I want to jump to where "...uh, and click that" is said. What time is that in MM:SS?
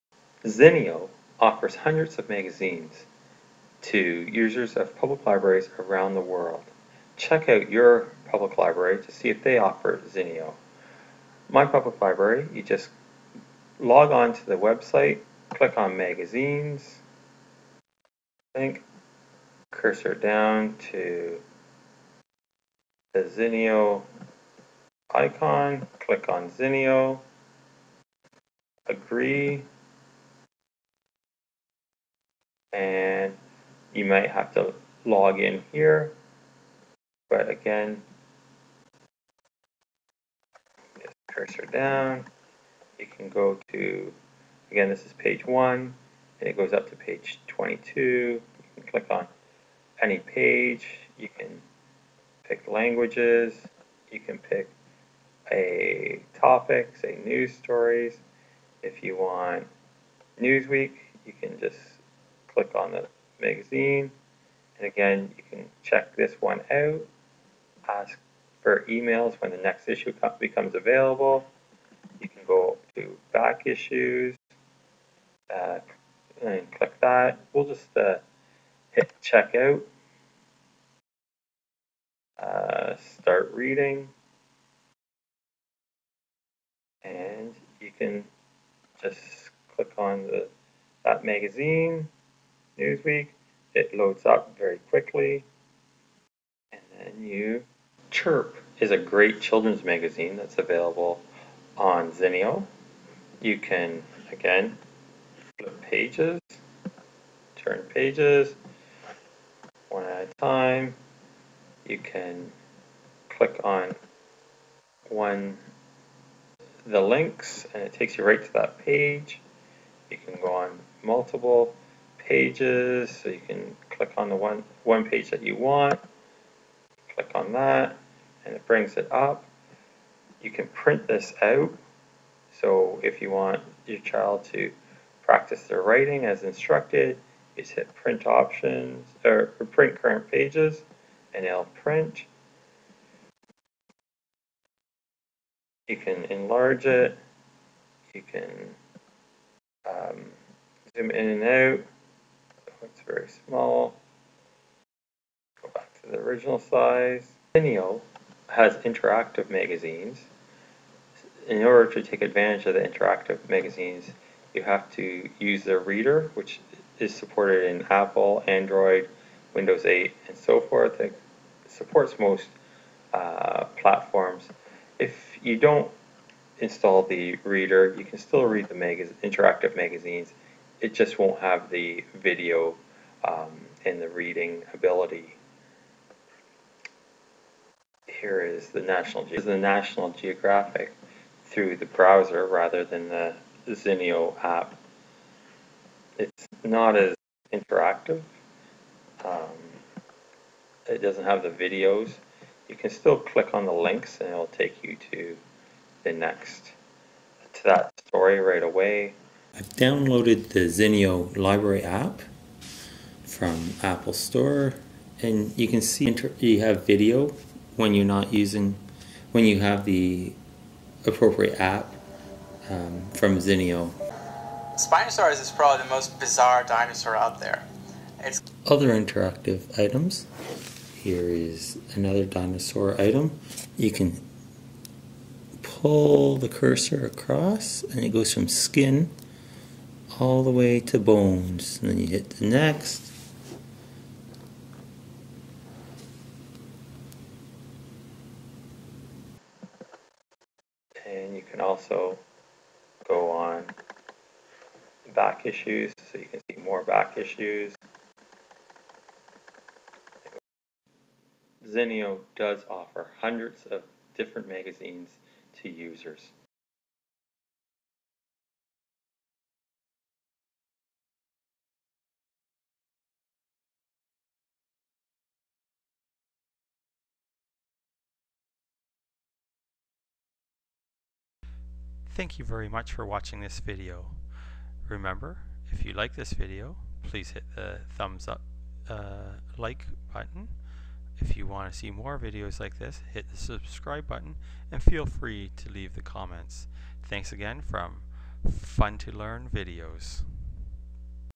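01:15.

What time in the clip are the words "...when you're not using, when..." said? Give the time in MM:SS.
03:37.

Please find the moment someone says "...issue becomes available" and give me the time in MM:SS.
01:09.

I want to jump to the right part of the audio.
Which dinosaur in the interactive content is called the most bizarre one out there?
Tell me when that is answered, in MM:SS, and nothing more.
03:44.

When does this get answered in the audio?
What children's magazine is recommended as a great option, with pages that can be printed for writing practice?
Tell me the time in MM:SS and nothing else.
01:38.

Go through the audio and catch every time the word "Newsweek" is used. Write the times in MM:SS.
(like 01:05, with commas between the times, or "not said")
01:00, 01:32.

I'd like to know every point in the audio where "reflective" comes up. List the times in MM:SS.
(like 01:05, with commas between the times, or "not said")
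not said.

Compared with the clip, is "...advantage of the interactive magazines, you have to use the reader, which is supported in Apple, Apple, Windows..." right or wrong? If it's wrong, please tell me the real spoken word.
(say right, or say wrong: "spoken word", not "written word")
wrong: "Android", not "Apple".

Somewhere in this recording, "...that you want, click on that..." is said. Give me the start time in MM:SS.
02:05.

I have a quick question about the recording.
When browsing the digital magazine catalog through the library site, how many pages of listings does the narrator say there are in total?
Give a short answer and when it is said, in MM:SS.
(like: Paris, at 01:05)
22, at 00:47.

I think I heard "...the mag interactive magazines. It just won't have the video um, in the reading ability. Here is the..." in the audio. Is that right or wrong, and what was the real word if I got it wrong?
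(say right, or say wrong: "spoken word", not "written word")
right.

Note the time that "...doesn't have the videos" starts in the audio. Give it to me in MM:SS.
03:21.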